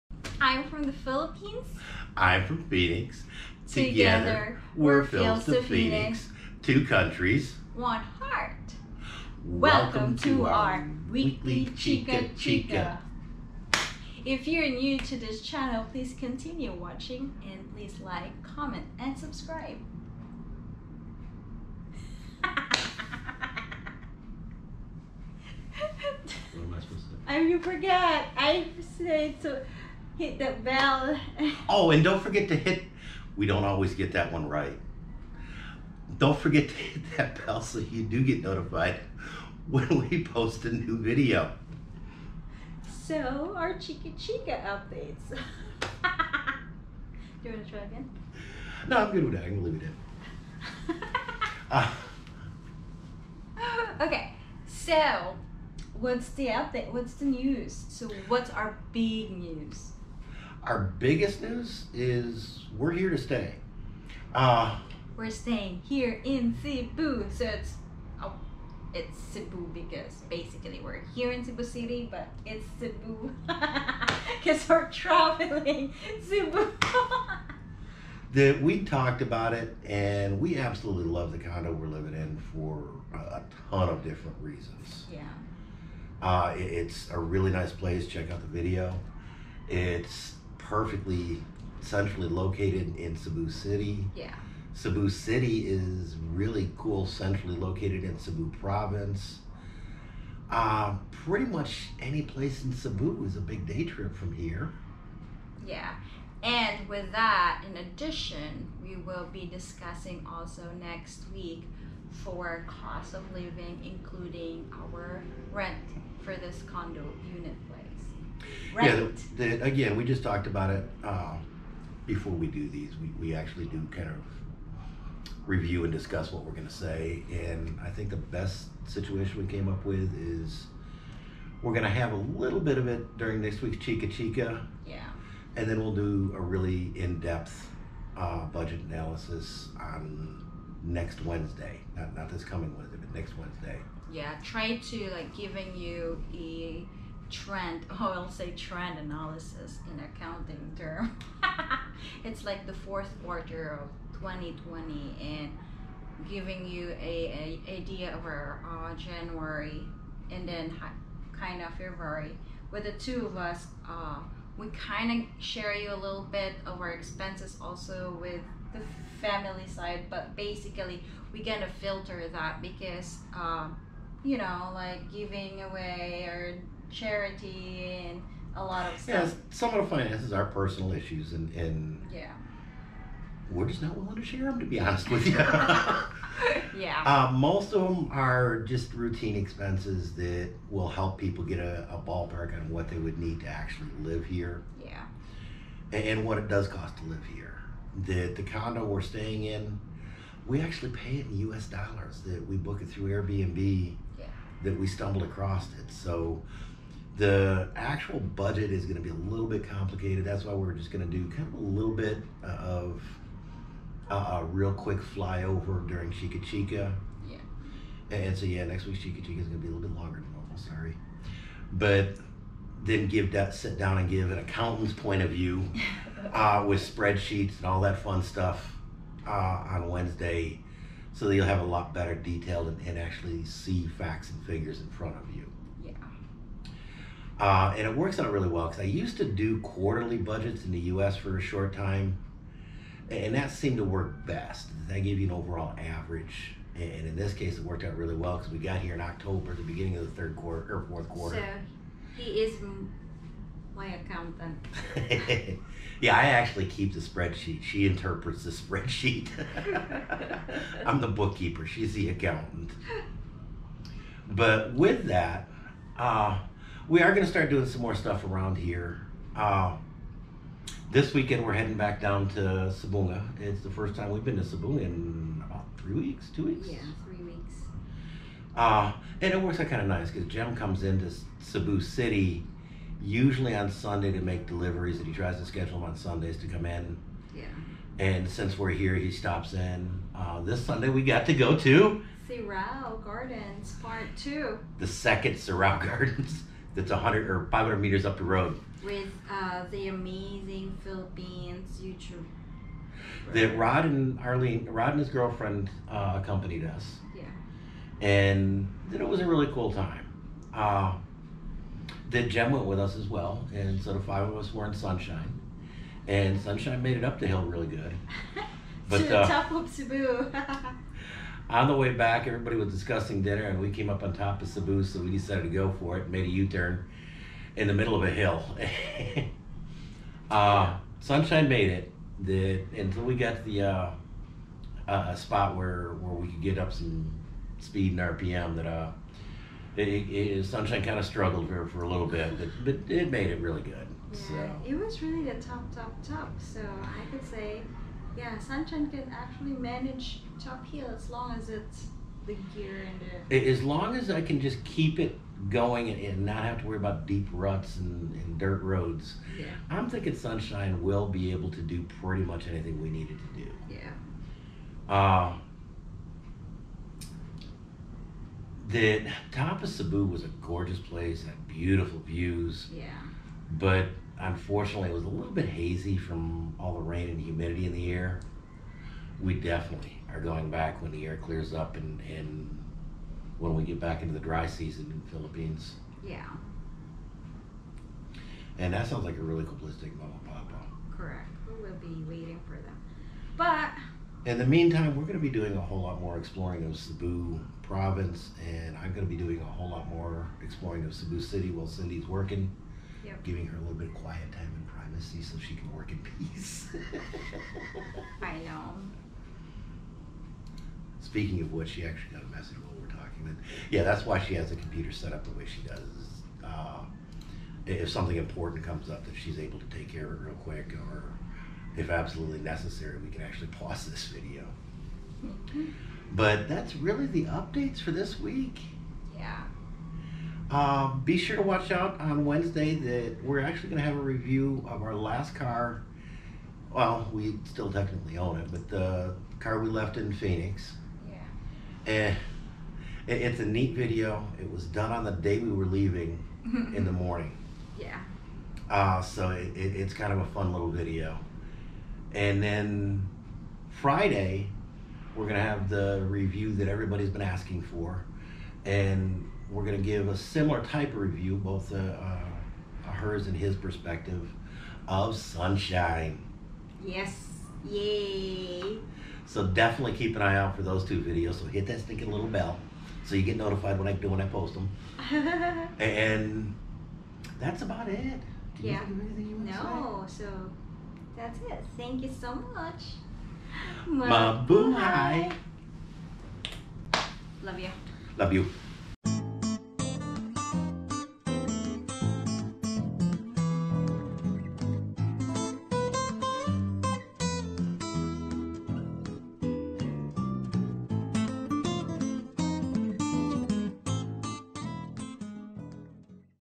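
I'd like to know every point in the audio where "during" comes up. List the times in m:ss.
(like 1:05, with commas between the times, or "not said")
2:13, 3:35.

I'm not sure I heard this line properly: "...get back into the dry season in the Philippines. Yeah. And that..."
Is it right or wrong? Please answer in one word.
right.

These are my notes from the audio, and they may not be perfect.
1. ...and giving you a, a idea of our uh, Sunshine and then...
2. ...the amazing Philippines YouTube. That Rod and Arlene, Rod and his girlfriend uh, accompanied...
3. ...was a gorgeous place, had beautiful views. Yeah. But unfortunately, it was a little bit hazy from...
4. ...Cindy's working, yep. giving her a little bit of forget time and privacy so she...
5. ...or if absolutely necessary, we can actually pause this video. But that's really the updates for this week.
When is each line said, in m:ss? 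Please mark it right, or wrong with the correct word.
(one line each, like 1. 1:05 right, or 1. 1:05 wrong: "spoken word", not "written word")
1. 2:35 wrong: "January", not "Sunshine"
2. 4:59 right
3. 6:10 right
4. 6:41 wrong: "quiet", not "forget"
5. 7:00 right.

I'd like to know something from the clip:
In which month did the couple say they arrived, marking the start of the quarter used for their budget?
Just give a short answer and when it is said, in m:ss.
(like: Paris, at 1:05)
October, at 4:09.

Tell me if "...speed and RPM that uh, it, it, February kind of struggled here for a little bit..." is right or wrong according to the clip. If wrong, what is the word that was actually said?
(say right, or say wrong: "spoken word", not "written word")
wrong: "Sunshine", not "February".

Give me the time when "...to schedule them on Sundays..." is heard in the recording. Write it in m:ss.
4:45.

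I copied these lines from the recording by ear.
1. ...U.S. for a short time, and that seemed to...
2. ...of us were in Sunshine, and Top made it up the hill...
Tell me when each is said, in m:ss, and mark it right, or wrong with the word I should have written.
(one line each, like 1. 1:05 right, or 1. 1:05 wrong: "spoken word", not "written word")
1. 4:00 right
2. 5:14 wrong: "Sunshine", not "Top".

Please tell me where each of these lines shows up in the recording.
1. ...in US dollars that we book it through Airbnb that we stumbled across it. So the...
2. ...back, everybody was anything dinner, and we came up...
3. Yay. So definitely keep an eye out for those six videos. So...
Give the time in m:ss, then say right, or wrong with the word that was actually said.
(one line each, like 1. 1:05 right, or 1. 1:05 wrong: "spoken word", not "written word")
1. 3:21 right
2. 5:21 wrong: "discussing", not "anything"
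3. 7:47 wrong: "two", not "six".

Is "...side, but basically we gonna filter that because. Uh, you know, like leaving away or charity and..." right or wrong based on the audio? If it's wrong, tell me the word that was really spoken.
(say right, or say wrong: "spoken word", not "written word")
wrong: "giving", not "leaving".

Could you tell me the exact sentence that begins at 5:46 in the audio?
So I could say, yeah, Sunshine can actually manage top heel as long as it's the gear and the.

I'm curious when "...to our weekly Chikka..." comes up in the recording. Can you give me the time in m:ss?
0:10.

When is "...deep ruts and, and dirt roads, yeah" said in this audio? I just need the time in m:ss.
5:57.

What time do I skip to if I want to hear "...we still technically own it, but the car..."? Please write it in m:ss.
7:17.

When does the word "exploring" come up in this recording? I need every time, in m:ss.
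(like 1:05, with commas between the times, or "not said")
6:36, 6:40.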